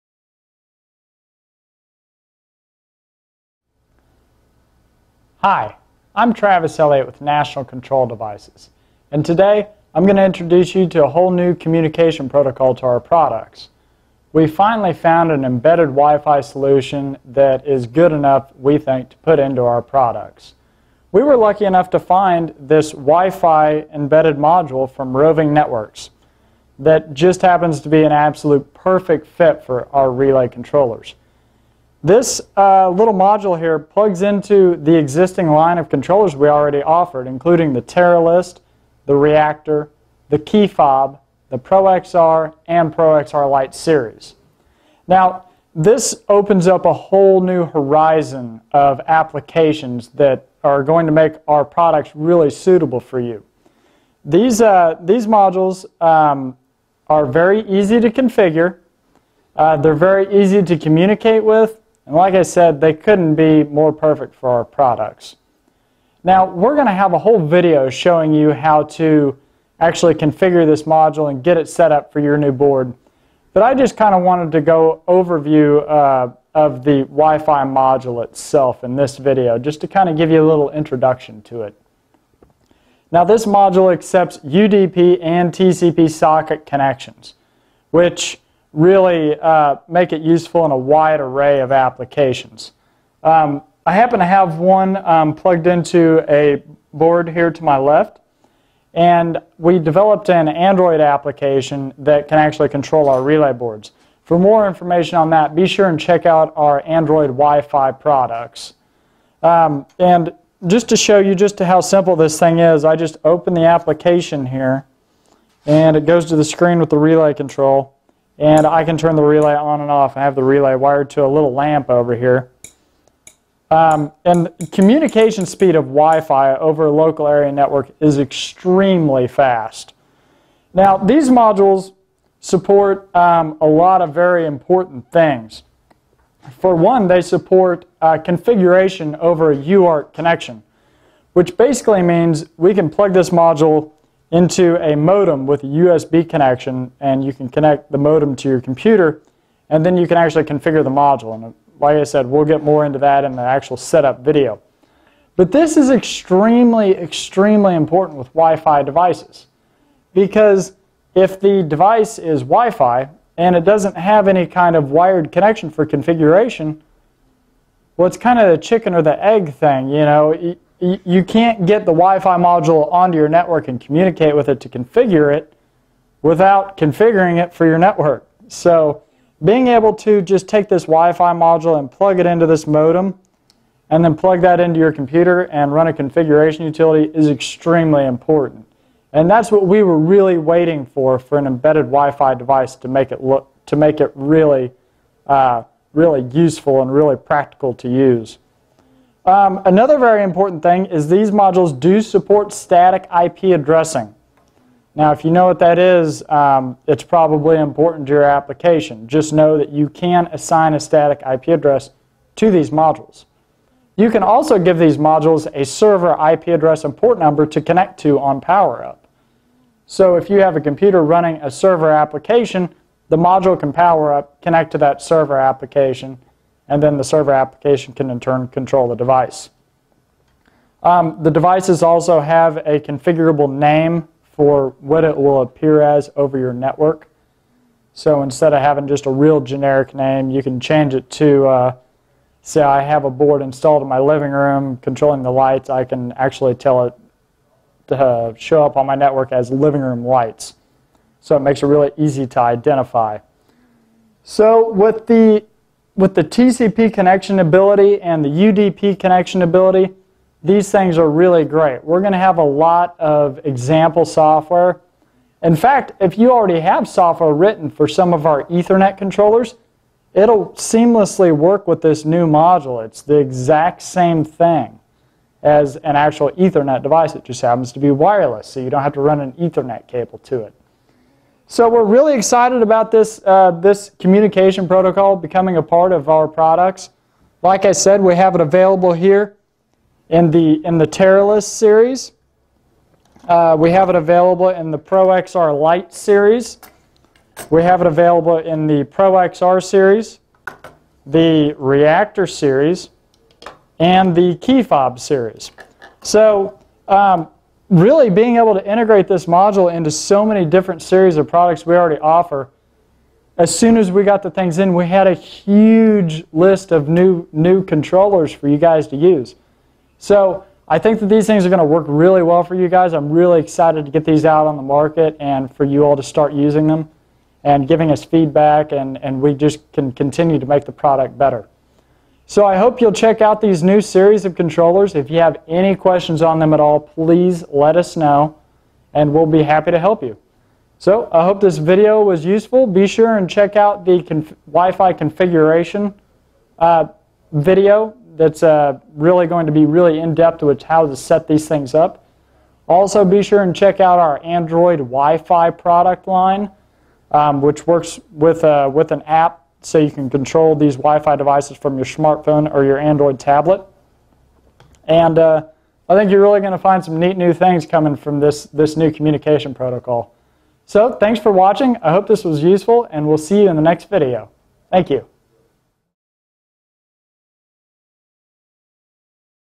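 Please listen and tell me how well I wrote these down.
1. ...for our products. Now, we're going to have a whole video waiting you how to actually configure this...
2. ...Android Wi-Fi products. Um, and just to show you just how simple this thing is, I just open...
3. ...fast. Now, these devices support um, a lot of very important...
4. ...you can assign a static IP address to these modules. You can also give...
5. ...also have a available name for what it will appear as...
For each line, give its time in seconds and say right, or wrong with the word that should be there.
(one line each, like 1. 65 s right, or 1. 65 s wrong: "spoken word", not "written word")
1. 64 s wrong: "showing", not "waiting"
2. 106 s right
3. 129 s wrong: "modules", not "devices"
4. 209 s right
5. 231 s wrong: "configurable", not "available".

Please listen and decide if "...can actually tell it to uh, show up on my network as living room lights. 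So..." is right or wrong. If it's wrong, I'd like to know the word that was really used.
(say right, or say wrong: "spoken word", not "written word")
right.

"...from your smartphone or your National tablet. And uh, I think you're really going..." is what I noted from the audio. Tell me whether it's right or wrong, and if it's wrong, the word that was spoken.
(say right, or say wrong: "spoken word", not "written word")
wrong: "Android", not "National".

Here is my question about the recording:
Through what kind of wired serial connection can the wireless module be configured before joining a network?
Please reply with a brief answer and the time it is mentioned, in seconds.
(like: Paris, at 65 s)
UART, at 139 s.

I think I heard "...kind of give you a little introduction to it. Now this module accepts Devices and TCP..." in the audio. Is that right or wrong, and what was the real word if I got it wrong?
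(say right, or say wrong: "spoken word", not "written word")
wrong: "UDP", not "Devices".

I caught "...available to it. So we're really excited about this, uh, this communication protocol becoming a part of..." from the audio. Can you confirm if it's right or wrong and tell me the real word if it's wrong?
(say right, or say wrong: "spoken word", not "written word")
wrong: "cable", not "available".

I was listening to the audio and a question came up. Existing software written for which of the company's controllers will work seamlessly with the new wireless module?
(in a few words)
Ethernet controllers.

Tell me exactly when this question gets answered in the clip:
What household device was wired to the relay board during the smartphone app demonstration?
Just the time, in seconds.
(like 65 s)
121 s.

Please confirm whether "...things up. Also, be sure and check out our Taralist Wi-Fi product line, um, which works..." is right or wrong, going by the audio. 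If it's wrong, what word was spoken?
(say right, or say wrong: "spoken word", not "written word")
wrong: "Android", not "Taralist".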